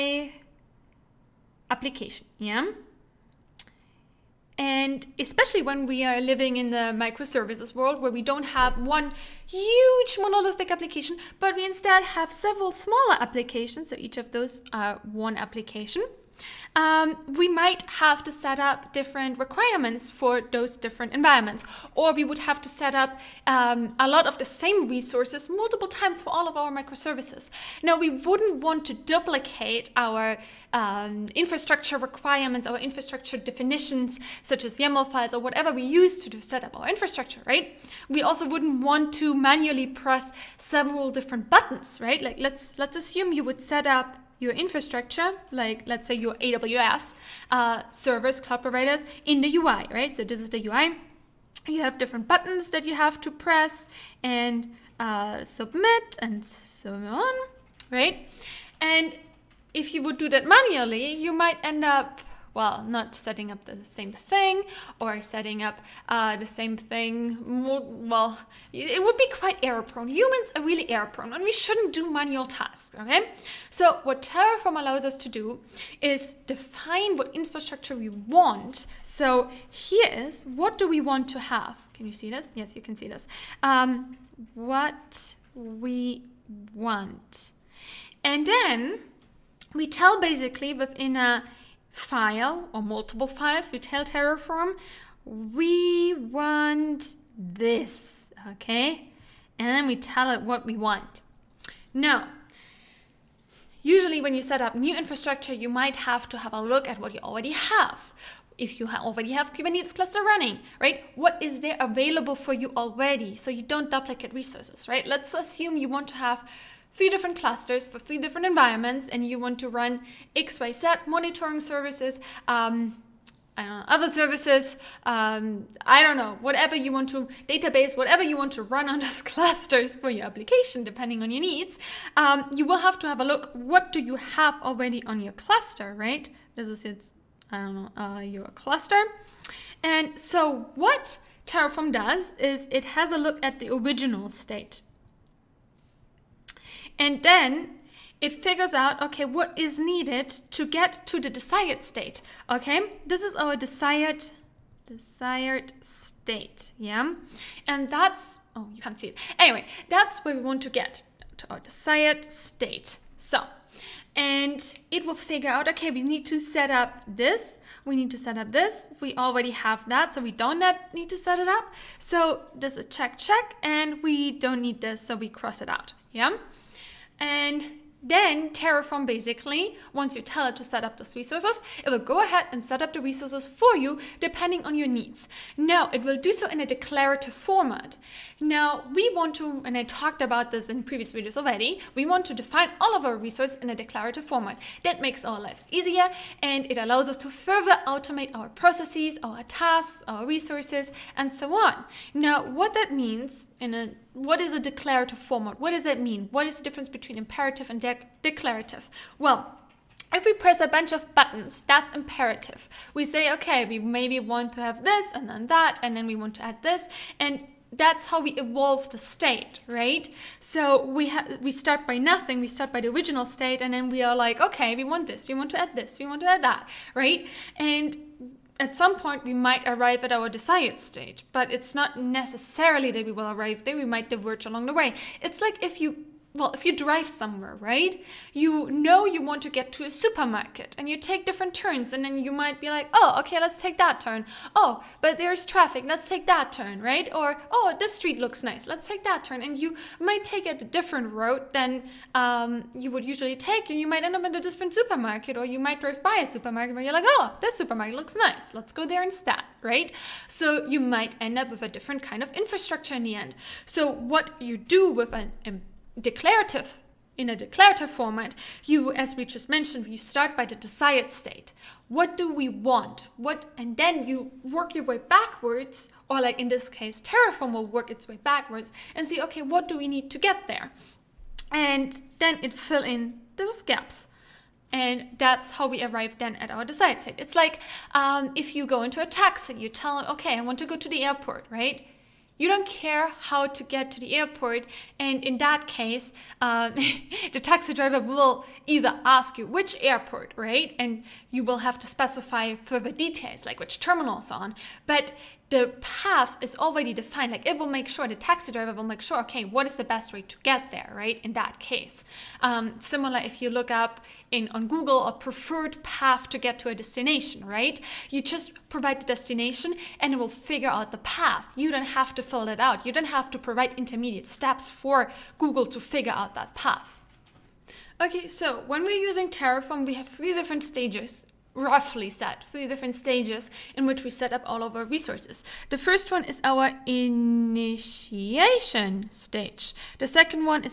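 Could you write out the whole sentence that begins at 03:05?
Now, it will do so in a declarative format.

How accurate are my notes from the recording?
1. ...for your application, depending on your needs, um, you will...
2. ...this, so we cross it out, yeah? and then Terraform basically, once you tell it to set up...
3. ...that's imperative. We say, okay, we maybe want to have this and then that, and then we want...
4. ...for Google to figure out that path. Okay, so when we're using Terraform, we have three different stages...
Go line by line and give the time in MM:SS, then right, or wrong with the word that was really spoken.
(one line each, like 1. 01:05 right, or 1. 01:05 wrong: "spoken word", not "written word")
1. 02:09 right
2. 02:54 right
3. 03:31 right
4. 05:24 right.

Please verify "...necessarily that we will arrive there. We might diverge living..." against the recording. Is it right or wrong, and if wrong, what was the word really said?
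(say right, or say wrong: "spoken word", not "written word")
wrong: "along", not "living".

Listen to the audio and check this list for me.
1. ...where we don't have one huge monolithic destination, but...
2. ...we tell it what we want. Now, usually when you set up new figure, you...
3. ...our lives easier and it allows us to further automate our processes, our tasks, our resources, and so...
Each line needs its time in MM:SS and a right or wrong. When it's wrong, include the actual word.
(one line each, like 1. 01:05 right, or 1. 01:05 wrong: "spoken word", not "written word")
1. 00:08 wrong: "application", not "destination"
2. 01:39 wrong: "infrastructure", not "figure"
3. 03:15 right.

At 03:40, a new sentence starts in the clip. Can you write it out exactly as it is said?
So we we start by nothing.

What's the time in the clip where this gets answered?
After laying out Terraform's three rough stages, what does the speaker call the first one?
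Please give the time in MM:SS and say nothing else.
05:36.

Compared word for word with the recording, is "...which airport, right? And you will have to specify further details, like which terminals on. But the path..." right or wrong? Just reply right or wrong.
right.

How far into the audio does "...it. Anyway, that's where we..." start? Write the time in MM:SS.
02:39.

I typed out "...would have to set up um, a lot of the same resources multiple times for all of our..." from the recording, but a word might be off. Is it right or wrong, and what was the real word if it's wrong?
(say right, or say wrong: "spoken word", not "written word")
right.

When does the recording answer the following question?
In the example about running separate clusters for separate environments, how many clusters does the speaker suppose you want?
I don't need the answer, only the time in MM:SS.
01:56.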